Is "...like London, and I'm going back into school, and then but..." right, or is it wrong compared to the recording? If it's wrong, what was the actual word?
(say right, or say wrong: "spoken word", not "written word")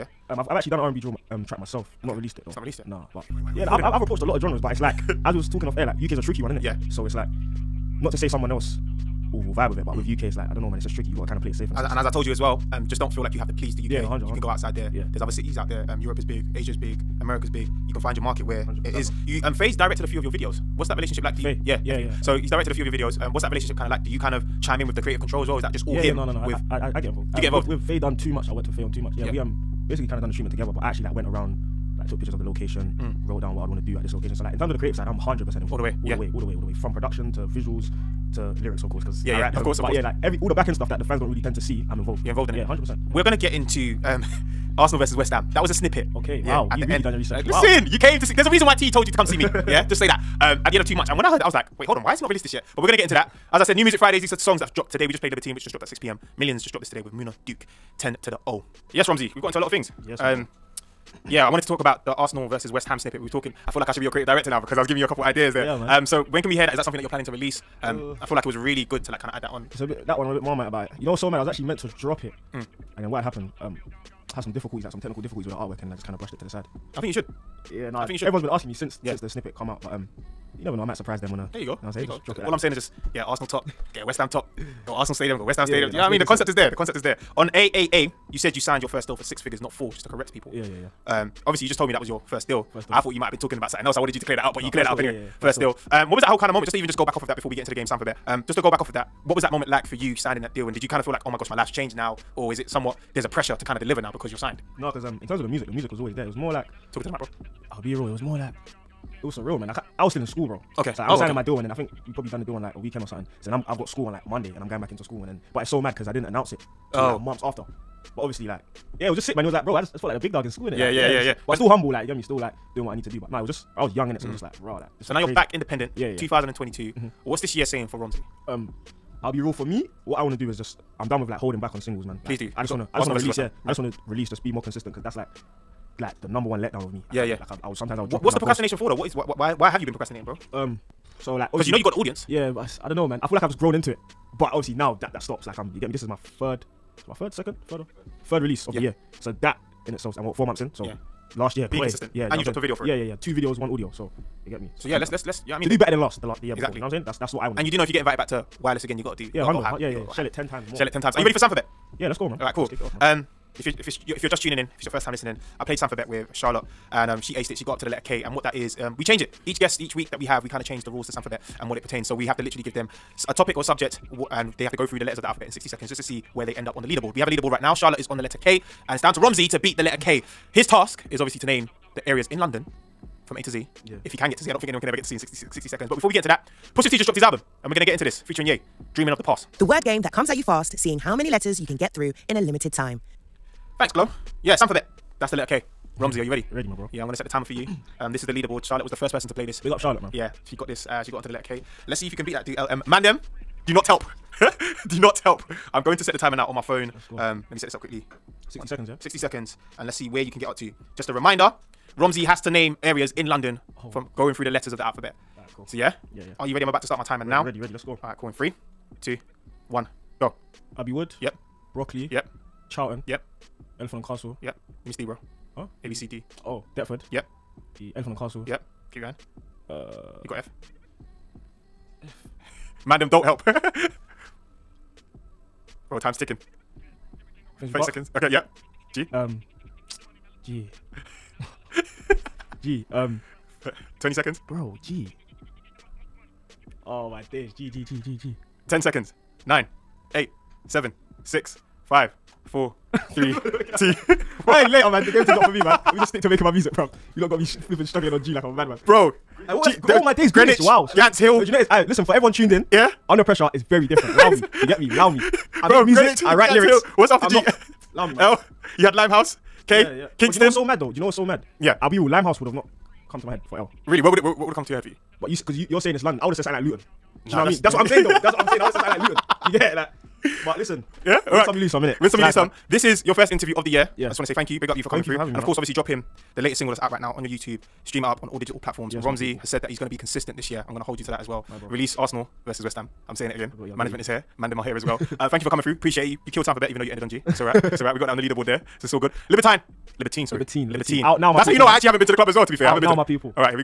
wrong: "Monday", not "London".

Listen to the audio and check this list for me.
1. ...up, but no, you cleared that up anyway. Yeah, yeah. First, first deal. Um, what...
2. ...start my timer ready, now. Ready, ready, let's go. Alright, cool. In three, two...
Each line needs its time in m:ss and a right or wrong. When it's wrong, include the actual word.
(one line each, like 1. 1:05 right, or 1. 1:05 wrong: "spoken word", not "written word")
1. 1:34 right
2. 3:36 right.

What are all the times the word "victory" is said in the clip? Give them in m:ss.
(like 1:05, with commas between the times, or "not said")
not said.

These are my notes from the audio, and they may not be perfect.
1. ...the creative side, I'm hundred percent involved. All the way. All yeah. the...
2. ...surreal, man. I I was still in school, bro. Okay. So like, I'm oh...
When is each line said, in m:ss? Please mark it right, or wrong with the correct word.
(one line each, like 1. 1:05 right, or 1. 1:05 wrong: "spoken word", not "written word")
1. 0:34 right
2. 1:49 right.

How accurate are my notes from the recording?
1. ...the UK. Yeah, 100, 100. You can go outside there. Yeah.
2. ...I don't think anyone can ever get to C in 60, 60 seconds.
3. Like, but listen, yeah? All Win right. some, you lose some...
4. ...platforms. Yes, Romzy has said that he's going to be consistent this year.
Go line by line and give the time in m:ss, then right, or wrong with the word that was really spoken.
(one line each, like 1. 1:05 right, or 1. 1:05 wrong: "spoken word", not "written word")
1. 0:13 right
2. 3:04 right
3. 4:39 right
4. 4:48 right.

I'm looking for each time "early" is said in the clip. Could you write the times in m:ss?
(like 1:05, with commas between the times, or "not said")
not said.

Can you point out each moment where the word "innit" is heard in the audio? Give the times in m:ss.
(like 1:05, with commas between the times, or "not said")
2:00, 4:41.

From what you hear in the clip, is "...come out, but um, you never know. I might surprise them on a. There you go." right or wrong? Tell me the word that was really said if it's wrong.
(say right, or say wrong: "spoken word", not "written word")
right.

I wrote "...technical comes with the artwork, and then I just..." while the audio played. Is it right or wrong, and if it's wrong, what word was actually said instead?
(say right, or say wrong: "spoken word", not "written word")
wrong: "difficulties", not "comes".